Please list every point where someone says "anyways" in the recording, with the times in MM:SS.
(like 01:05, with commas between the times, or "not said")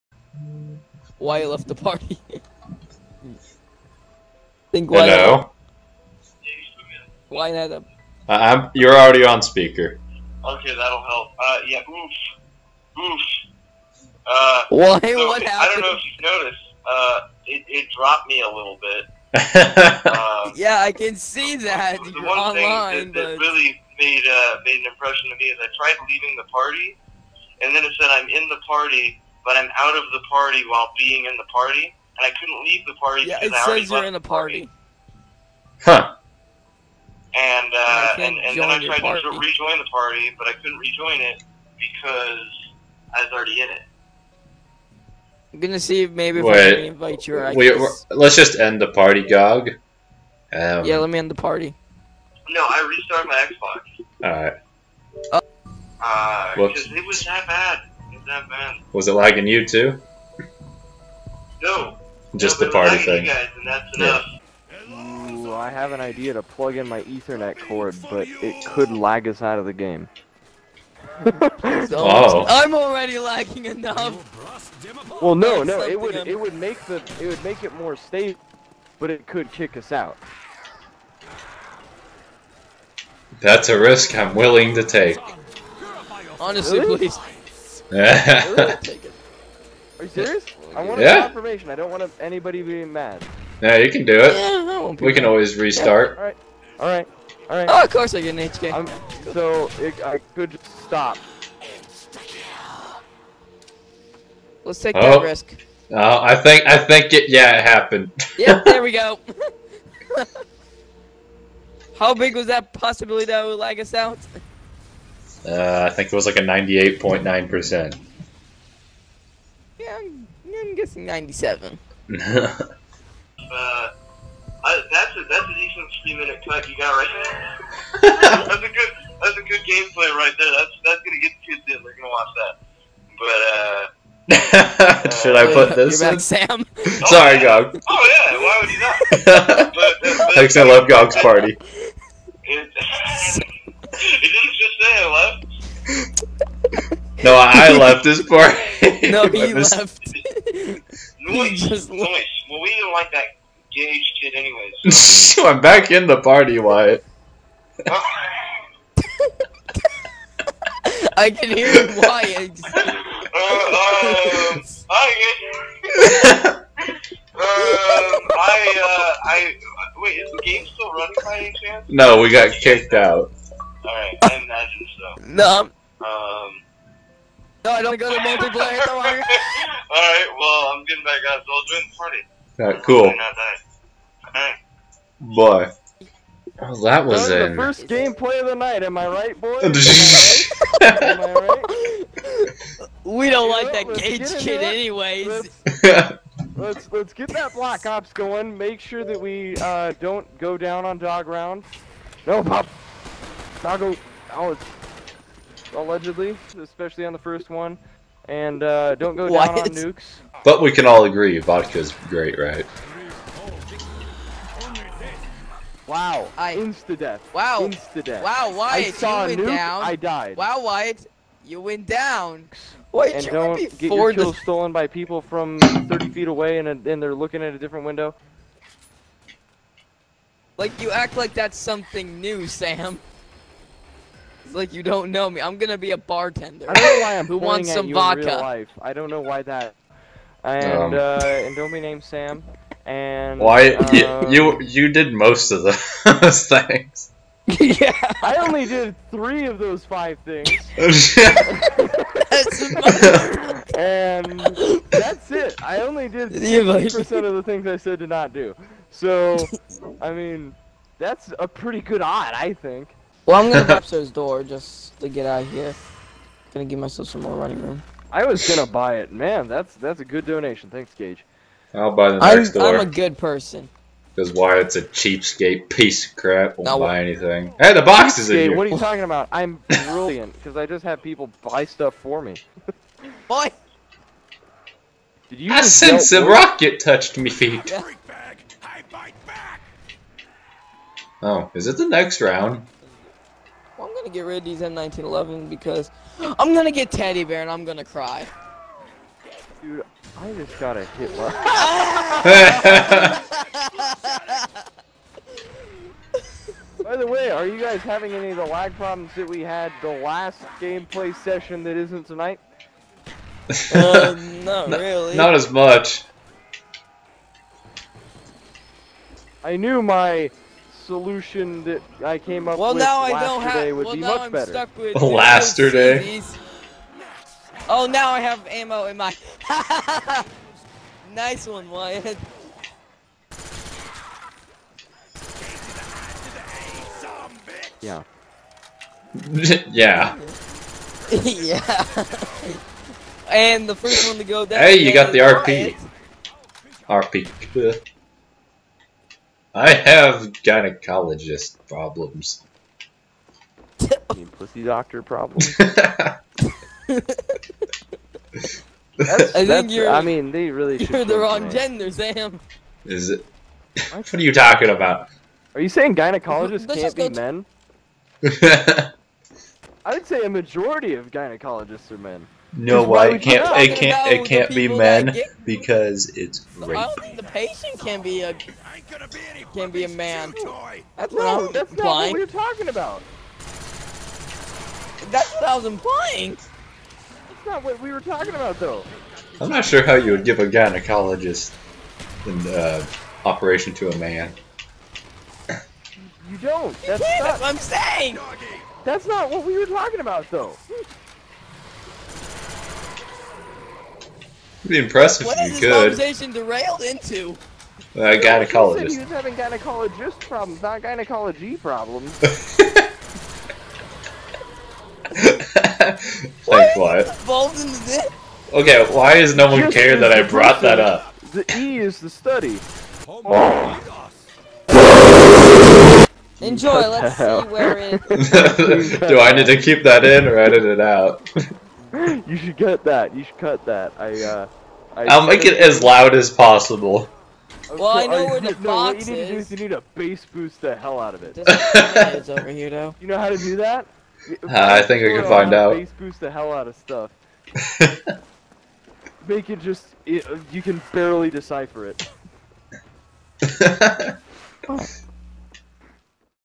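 02:34, 03:14.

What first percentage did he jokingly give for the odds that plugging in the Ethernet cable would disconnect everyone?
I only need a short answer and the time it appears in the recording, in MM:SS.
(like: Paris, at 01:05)
98.9%, at 01:56.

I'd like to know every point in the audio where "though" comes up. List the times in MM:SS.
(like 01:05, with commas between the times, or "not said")
06:28, 06:40, 07:22.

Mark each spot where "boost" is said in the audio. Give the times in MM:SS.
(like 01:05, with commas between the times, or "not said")
07:20, 07:25.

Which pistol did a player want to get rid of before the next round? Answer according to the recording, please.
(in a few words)
M1911.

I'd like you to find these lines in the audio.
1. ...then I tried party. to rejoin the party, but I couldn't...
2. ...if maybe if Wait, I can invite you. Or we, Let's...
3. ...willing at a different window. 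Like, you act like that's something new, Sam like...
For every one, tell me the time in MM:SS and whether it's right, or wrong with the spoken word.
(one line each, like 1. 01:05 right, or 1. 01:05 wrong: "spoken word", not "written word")
1. 00:38 right
2. 00:46 right
3. 03:47 wrong: "looking", not "willing".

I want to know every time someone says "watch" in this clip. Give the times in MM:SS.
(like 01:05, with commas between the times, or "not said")
02:12.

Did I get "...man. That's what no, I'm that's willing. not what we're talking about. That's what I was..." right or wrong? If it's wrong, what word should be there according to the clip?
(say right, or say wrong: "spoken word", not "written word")
wrong: "implying", not "willing".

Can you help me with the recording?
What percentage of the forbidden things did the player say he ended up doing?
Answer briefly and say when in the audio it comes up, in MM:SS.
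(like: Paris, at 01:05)
60%, at 04:16.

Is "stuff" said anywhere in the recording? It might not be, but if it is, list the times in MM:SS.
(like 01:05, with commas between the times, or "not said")
04:41, 07:26.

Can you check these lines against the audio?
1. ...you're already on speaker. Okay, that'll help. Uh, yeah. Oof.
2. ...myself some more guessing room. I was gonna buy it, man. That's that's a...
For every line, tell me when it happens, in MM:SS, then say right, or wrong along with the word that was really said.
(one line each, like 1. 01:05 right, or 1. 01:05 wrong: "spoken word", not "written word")
1. 00:08 right
2. 04:26 wrong: "running", not "guessing".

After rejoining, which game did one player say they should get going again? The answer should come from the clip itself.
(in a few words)
Black Ops.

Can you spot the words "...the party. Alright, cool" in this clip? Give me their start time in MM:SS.
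03:01.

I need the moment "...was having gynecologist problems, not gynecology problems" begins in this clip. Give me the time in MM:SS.
06:48.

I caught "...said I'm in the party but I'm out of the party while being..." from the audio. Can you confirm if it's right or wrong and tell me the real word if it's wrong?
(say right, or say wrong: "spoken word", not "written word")
right.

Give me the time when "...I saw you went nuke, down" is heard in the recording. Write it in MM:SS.
03:38.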